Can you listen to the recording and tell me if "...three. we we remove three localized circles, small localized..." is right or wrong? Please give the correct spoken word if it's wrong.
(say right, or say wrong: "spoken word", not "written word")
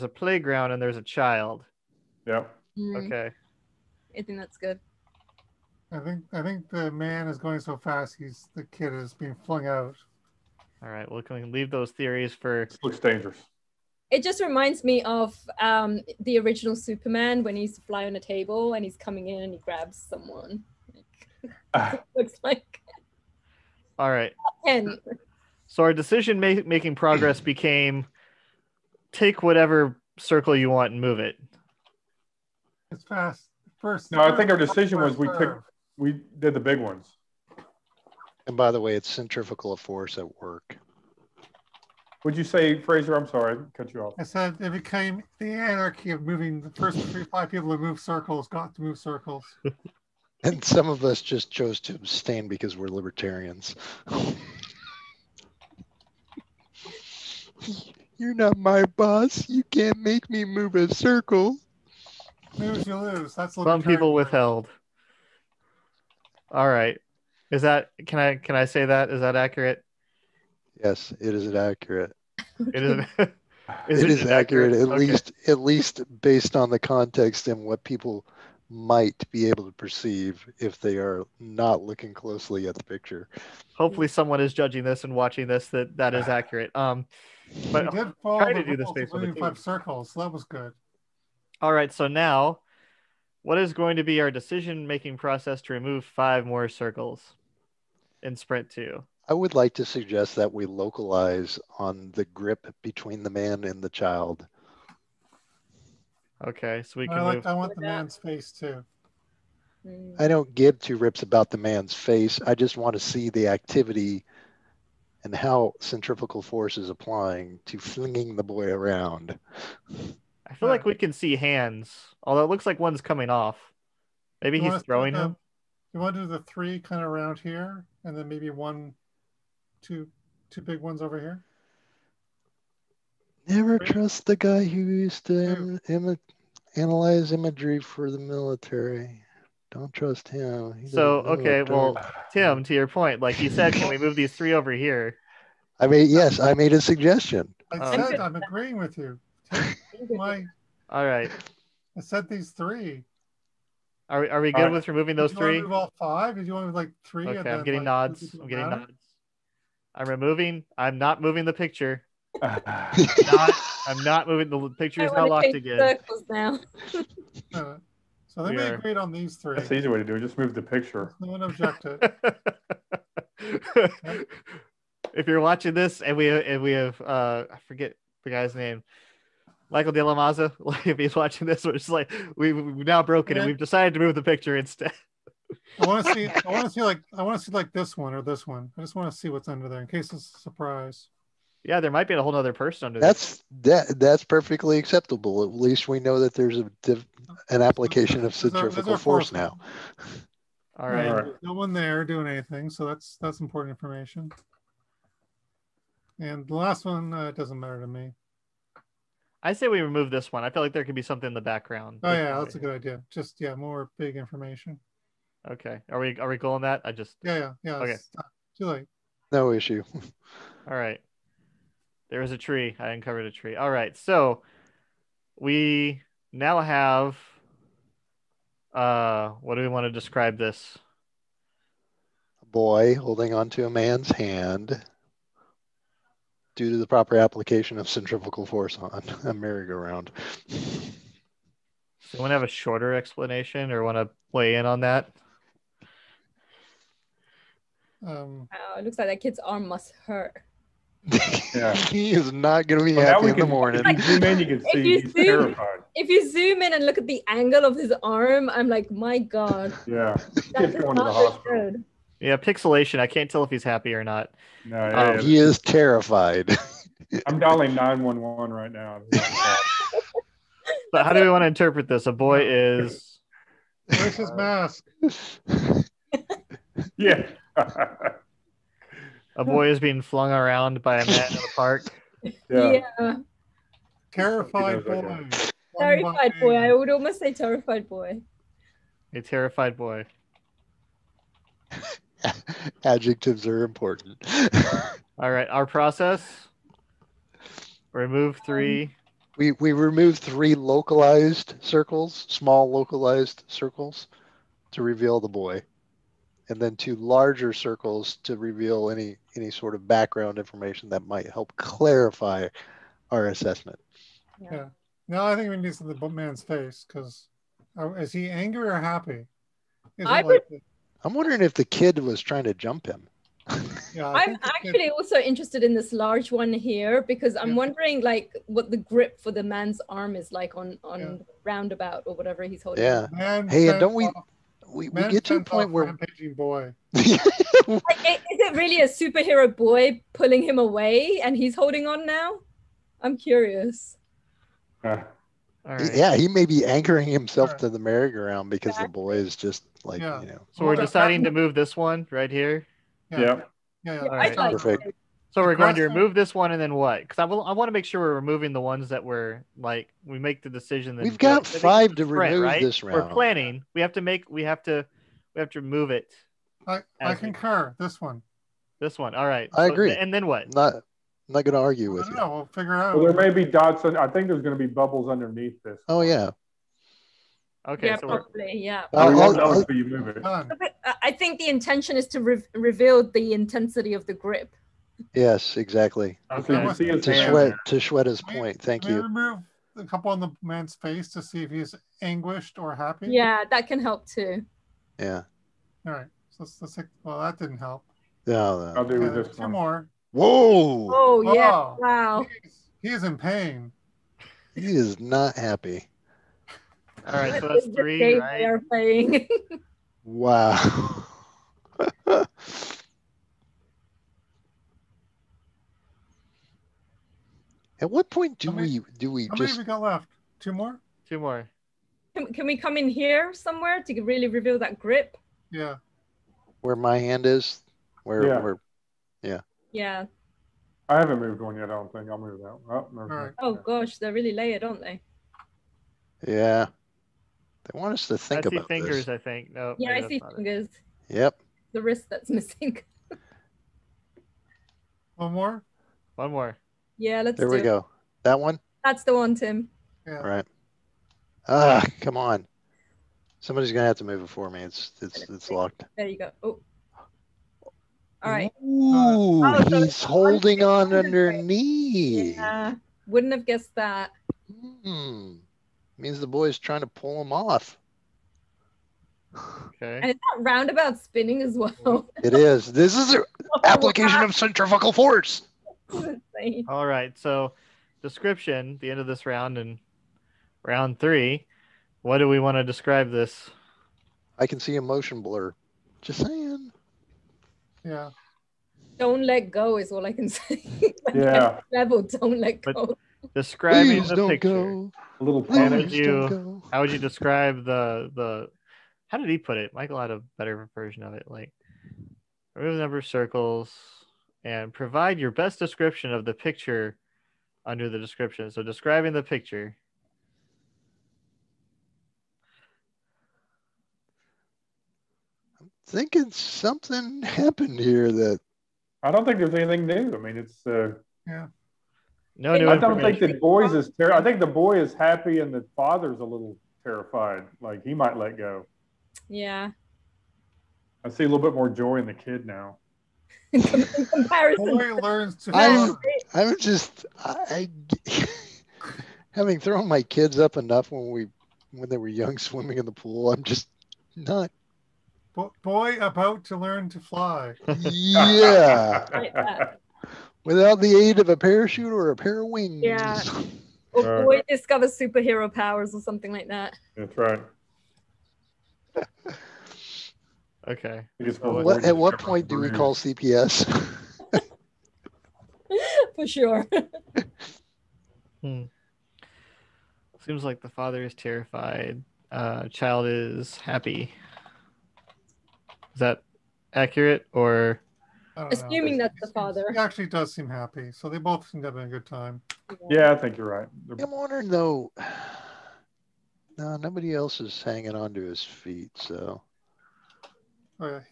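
right.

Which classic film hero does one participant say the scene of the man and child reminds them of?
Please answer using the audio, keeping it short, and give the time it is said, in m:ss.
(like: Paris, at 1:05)
Superman, at 0:16.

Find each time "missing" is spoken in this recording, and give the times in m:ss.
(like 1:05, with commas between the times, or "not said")
7:22.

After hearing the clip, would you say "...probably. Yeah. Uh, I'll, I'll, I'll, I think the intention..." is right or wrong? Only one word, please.
right.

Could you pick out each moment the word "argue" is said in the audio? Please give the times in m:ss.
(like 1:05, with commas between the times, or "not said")
6:11.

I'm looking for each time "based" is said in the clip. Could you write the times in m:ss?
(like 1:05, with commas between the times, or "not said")
1:16, 1:28.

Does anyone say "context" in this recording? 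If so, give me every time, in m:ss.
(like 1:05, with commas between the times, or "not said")
1:16.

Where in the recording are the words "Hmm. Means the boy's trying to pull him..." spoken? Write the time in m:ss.
7:44.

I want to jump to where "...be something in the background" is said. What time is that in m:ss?
3:30.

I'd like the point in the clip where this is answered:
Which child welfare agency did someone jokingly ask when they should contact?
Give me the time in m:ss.
9:22.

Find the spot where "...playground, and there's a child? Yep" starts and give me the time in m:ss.
0:00.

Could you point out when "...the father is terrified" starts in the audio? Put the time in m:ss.
9:30.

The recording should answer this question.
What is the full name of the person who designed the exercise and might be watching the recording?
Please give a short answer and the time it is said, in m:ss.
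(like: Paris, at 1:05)
Michael De La Maza, at 2:59.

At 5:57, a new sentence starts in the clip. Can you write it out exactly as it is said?
Because I, will, I want to make sure we're removing the ones that we're like we make the decision.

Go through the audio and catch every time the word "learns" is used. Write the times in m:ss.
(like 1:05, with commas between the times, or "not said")
8:54, 9:06.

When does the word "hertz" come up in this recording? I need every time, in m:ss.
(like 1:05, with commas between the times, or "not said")
not said.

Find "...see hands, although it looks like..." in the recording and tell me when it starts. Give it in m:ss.
2:01.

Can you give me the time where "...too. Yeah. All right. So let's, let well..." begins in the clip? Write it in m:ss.
6:34.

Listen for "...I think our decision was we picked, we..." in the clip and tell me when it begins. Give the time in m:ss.
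0:34.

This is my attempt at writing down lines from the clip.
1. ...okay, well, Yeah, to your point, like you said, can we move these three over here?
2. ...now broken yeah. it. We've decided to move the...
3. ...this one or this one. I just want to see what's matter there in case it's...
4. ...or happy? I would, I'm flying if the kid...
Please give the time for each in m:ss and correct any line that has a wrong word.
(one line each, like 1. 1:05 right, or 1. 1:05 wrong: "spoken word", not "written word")
1. 2:21 wrong: "Tim", not "Yeah"
2. 3:02 right
3. 3:07 wrong: "under", not "matter"
4. 5:18 wrong: "wondering", not "flying".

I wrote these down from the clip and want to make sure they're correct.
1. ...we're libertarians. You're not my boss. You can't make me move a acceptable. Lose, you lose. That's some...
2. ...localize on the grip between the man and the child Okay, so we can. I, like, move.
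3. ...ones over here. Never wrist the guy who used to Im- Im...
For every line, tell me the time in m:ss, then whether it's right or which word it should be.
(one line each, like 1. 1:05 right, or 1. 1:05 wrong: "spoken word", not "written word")
1. 0:52 wrong: "circle", not "acceptable"
2. 1:40 right
3. 2:10 wrong: "trust", not "wrist".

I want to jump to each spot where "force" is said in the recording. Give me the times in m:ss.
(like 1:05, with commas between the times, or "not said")
0:39, 1:56, 3:18, 3:58, 7:54.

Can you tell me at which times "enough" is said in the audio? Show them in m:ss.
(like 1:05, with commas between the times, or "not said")
9:00.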